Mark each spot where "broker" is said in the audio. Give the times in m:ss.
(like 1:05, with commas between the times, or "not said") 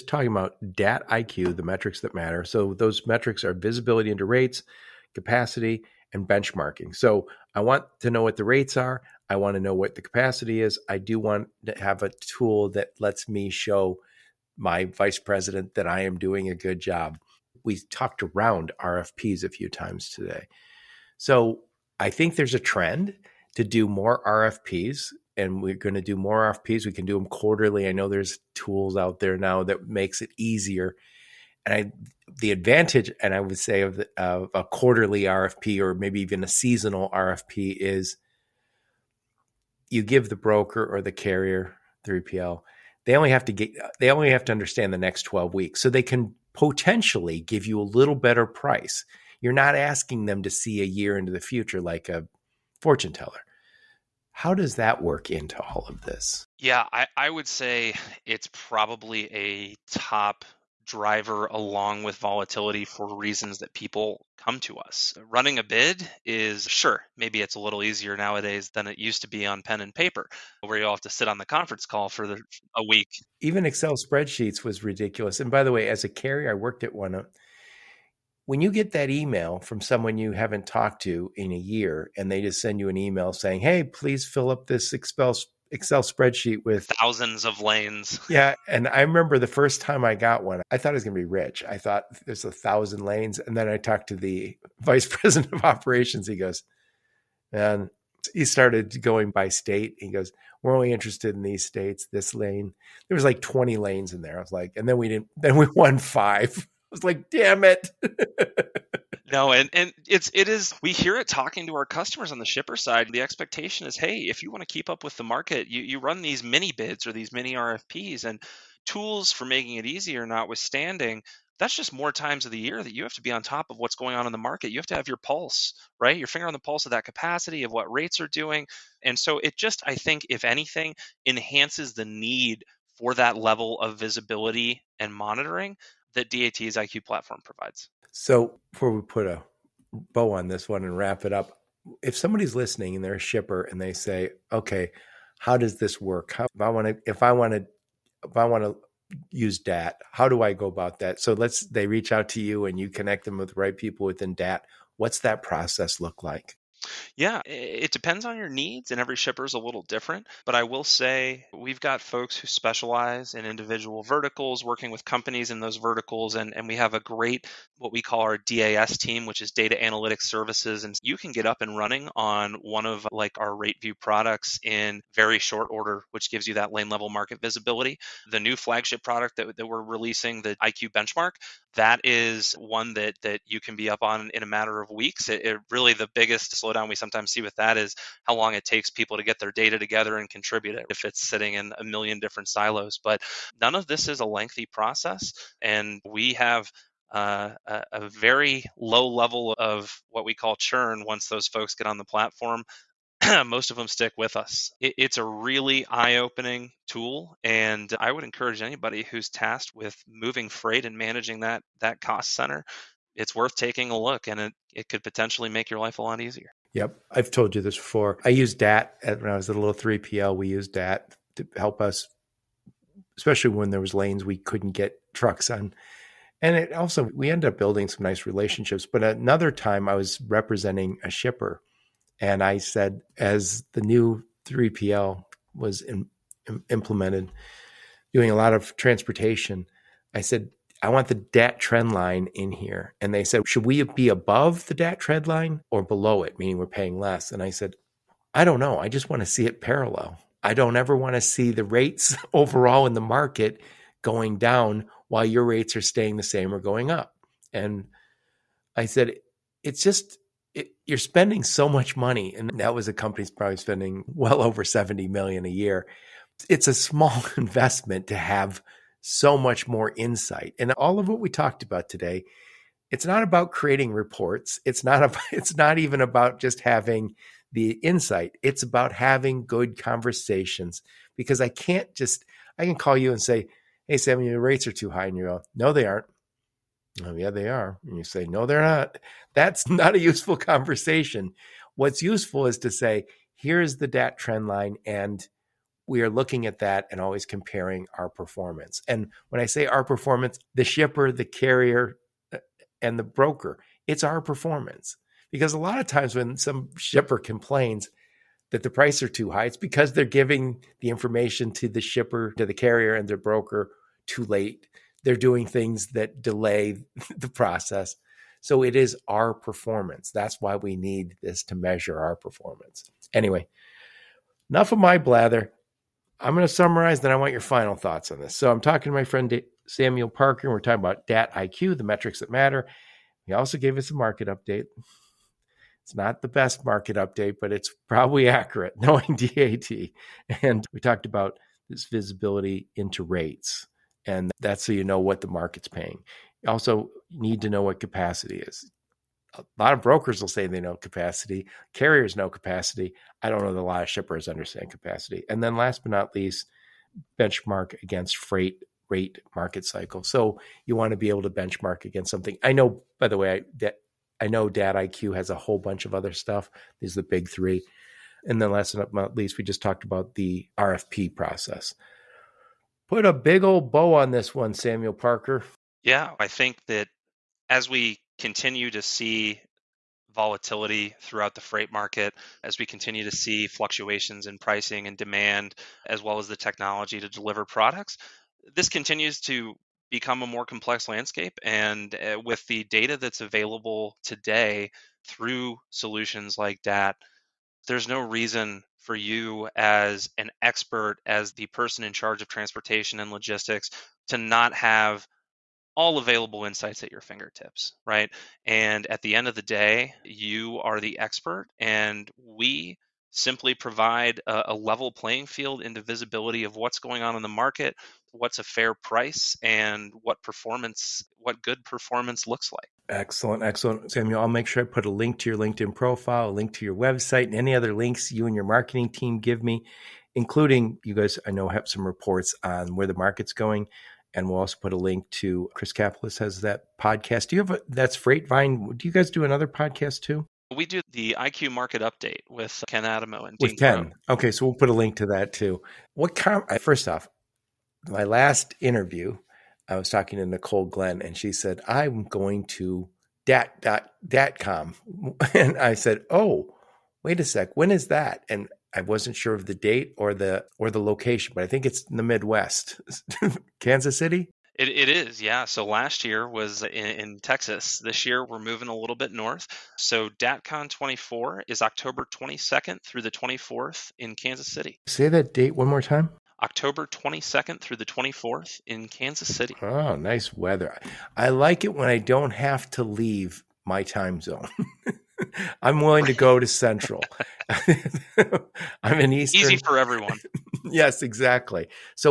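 0:40, 5:03, 5:13, 5:49.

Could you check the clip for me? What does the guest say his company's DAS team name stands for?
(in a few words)
Data analytics services.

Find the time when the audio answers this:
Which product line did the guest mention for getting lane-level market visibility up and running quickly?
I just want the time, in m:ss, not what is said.
2:53.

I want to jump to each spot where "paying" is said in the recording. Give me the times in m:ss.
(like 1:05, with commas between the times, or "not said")
4:06, 5:45.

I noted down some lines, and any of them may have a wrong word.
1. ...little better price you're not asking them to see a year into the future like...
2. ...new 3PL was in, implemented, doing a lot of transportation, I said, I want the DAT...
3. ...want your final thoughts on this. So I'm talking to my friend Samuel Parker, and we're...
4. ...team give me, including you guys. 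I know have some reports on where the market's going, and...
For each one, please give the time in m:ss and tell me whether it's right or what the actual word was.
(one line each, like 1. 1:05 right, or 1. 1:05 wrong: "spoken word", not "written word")
1. 0:47 right
2. 3:53 right
3. 5:27 right
4. 7:08 right.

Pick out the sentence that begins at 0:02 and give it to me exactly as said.
So those metrics are visibility into rates, capacity, and benchmarking.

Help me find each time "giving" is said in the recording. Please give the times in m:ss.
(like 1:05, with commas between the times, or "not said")
5:10.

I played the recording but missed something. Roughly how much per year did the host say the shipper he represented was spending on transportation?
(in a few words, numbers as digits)
Over $70 million.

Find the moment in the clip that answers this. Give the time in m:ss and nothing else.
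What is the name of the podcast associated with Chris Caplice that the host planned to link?
7:17.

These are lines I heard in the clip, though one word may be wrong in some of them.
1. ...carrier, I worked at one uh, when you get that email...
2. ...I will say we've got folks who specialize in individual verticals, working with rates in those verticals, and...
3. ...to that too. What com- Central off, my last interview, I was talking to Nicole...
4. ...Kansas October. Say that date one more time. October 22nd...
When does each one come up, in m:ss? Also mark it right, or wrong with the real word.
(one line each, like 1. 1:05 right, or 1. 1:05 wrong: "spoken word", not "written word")
1. 1:16 right
2. 2:40 wrong: "companies", not "rates"
3. 7:24 wrong: "First", not "Central"
4. 7:54 wrong: "City", not "October".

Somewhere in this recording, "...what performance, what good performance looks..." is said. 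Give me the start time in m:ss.
7:00.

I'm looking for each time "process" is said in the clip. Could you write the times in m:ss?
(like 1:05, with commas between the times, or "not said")
2:35, 3:14, 5:17, 6:11.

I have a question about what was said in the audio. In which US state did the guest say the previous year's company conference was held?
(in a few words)
Texas.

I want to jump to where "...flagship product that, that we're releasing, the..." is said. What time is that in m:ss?
2:58.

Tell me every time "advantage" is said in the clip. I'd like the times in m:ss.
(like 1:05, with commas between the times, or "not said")
0:32.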